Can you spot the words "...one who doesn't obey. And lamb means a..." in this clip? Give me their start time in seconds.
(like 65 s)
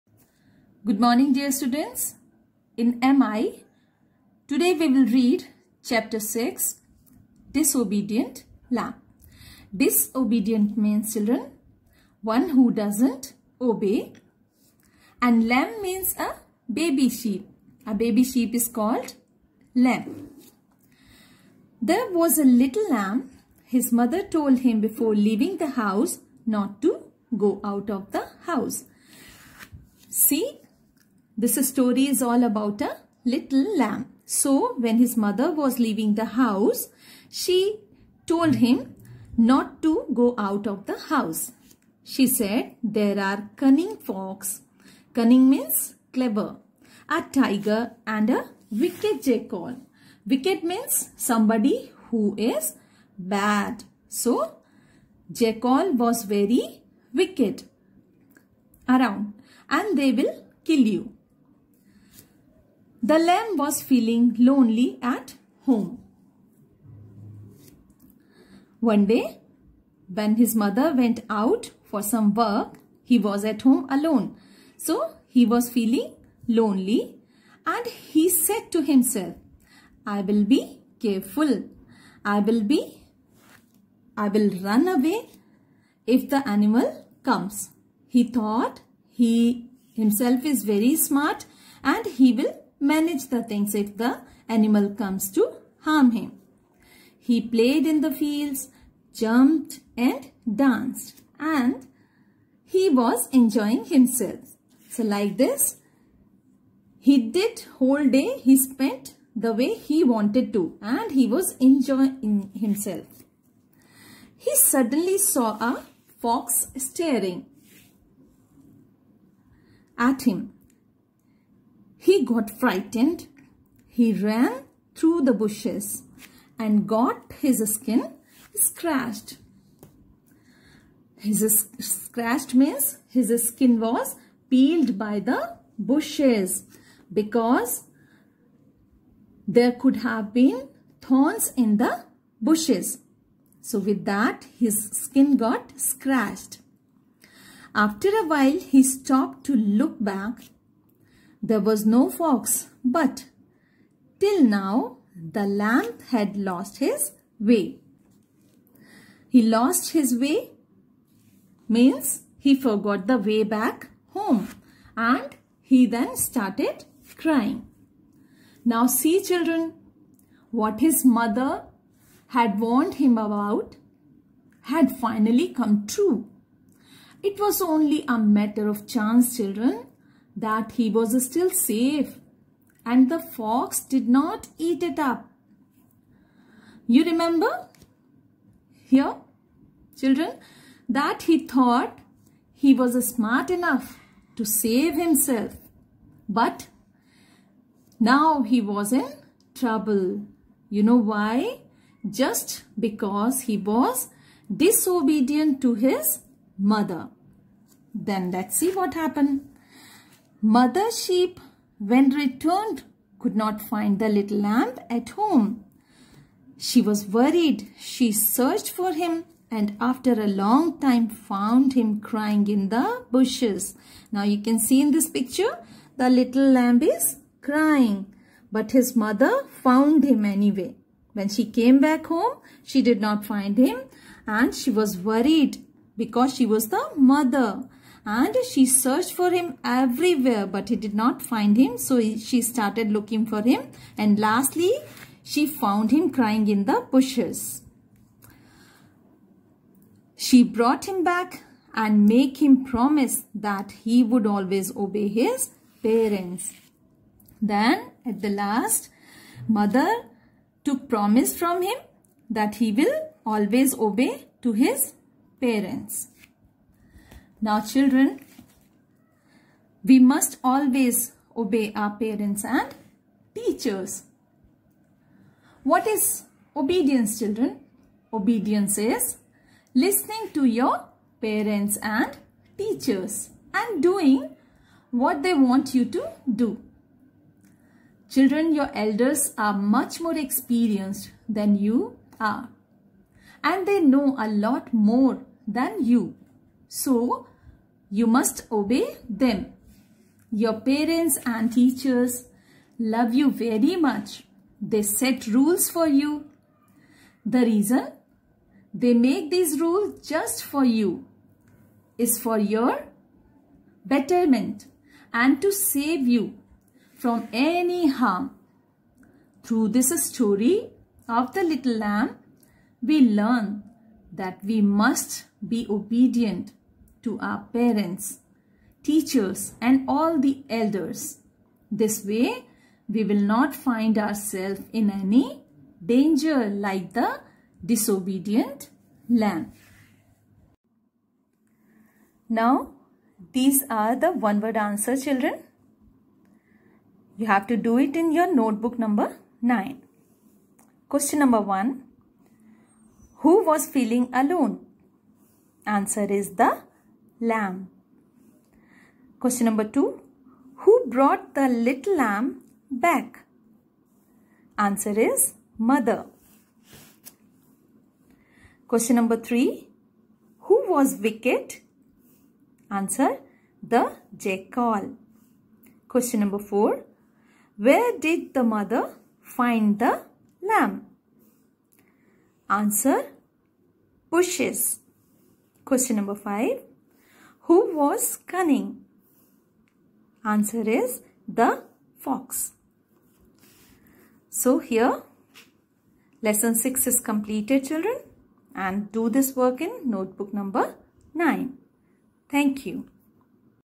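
12 s.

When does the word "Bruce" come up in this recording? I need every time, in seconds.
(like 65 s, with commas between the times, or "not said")
not said.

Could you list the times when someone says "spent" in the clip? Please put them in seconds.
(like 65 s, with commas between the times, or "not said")
108 s.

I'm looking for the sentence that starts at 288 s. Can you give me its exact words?
Children, your elders are much more experienced than you are and they know a lot more than you.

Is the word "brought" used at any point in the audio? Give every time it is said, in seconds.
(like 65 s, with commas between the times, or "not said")
250 s, 360 s.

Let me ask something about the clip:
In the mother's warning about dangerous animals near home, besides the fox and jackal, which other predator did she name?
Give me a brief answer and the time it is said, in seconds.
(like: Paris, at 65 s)
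A tiger, at 47 s.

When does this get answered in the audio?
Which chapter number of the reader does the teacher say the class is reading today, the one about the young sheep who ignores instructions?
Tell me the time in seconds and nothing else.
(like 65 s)
5 s.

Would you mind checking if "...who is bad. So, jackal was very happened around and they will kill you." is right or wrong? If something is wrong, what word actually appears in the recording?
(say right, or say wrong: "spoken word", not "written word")
wrong: "wicked", not "happened".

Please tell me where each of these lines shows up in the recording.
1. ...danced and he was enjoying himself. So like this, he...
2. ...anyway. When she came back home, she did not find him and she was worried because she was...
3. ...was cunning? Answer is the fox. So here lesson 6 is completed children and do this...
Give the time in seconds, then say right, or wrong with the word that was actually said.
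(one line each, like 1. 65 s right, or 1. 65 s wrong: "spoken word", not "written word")
1. 100 s right
2. 230 s right
3. 387 s right.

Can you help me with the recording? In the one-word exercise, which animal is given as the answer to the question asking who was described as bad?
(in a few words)
The jackal.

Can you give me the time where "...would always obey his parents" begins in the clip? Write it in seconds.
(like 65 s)
254 s.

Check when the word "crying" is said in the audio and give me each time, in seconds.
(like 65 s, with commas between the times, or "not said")
167 s, 221 s, 227 s, 246 s.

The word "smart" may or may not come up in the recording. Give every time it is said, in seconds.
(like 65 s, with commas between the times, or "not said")
90 s, 193 s.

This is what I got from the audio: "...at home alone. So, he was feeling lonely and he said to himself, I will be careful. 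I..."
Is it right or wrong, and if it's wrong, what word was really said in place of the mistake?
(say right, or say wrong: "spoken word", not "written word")
right.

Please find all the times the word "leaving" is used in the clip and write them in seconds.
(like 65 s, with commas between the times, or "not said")
25 s, 35 s.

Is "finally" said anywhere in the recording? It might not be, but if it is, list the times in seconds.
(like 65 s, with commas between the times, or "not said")
174 s.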